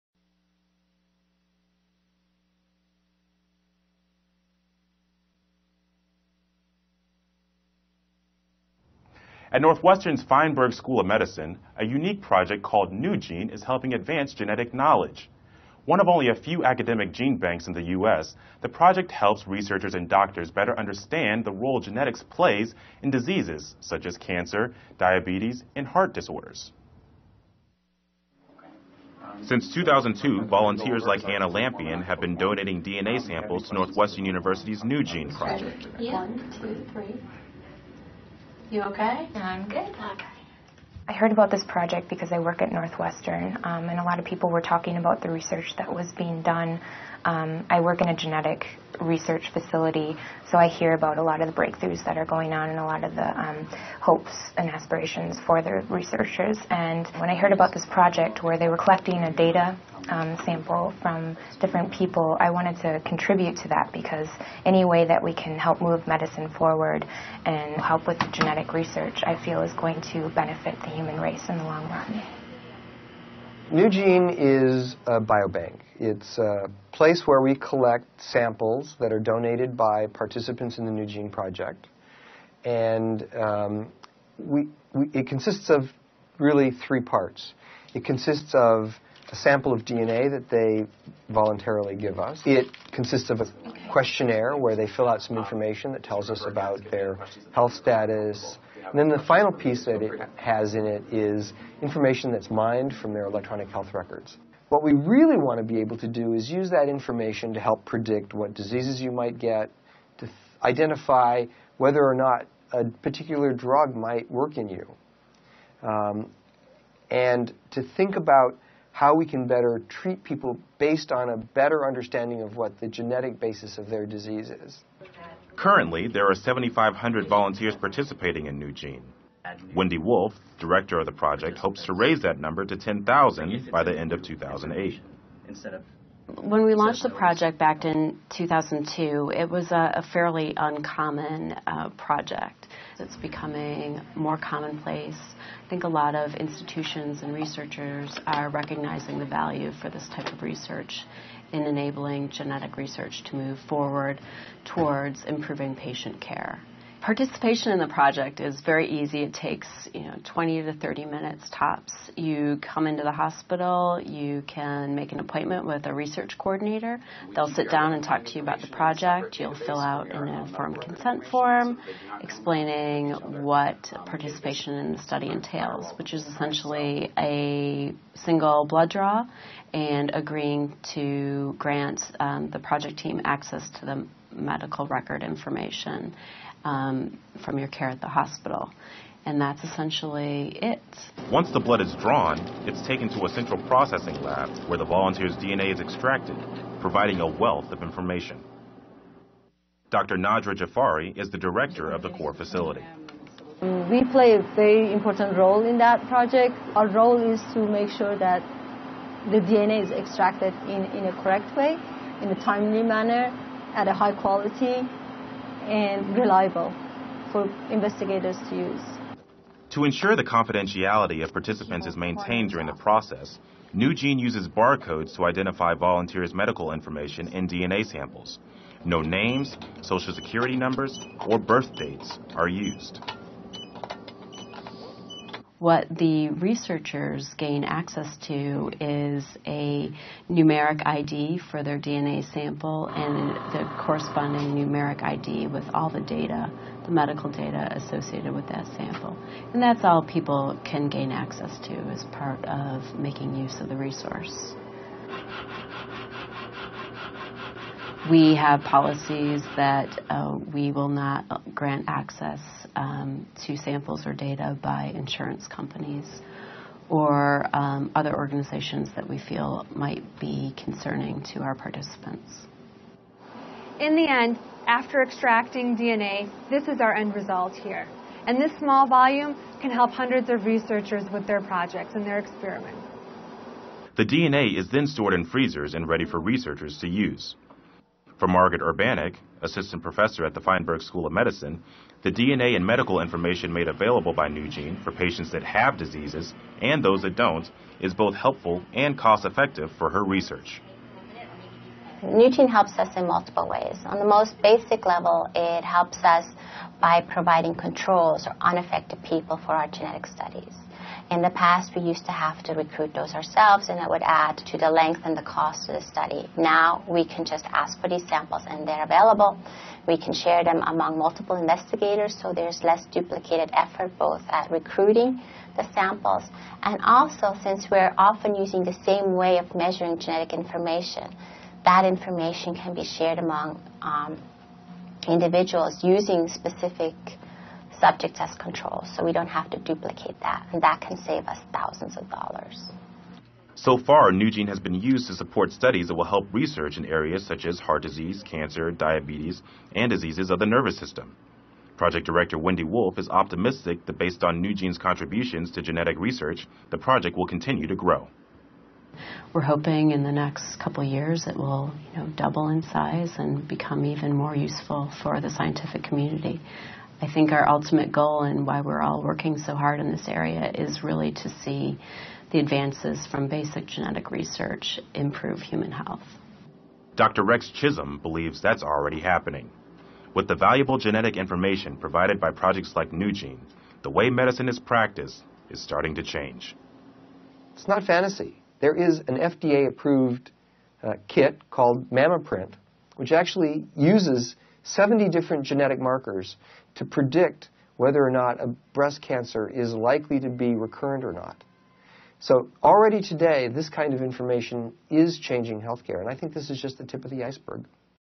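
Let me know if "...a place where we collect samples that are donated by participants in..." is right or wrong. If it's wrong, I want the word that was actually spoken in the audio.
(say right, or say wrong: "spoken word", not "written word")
right.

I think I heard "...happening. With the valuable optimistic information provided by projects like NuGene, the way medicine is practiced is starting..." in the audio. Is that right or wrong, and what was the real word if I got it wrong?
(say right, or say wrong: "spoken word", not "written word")
wrong: "genetic", not "optimistic".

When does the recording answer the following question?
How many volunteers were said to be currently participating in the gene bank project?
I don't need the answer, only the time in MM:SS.
02:06.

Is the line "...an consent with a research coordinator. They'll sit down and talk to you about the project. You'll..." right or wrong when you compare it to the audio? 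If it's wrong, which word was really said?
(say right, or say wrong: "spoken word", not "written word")
wrong: "appointment", not "consent".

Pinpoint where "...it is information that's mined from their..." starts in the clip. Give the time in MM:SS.
01:40.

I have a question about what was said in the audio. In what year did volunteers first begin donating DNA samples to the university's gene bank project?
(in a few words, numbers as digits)
2002.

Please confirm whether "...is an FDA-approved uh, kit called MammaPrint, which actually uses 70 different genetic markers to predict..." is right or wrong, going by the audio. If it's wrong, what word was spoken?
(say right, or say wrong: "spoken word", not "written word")
right.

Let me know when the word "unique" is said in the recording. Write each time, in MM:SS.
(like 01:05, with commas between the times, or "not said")
00:11.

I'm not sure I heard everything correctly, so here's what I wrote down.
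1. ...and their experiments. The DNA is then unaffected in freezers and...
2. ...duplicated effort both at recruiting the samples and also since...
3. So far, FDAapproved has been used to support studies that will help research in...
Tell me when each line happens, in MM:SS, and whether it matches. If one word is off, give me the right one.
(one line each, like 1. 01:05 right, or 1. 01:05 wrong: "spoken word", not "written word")
1. 04:41 wrong: "stored", not "unaffected"
2. 05:22 right
3. 05:43 wrong: "NuGene", not "FDAapproved".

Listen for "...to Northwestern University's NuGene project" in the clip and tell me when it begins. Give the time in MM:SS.
00:33.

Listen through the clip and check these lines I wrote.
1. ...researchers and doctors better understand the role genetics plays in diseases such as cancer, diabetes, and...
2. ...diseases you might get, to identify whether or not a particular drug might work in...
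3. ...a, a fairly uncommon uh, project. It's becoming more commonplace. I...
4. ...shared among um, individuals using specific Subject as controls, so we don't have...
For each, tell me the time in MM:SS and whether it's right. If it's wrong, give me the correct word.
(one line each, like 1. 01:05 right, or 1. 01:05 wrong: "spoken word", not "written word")
1. 00:19 right
2. 01:48 right
3. 02:19 right
4. 05:32 right.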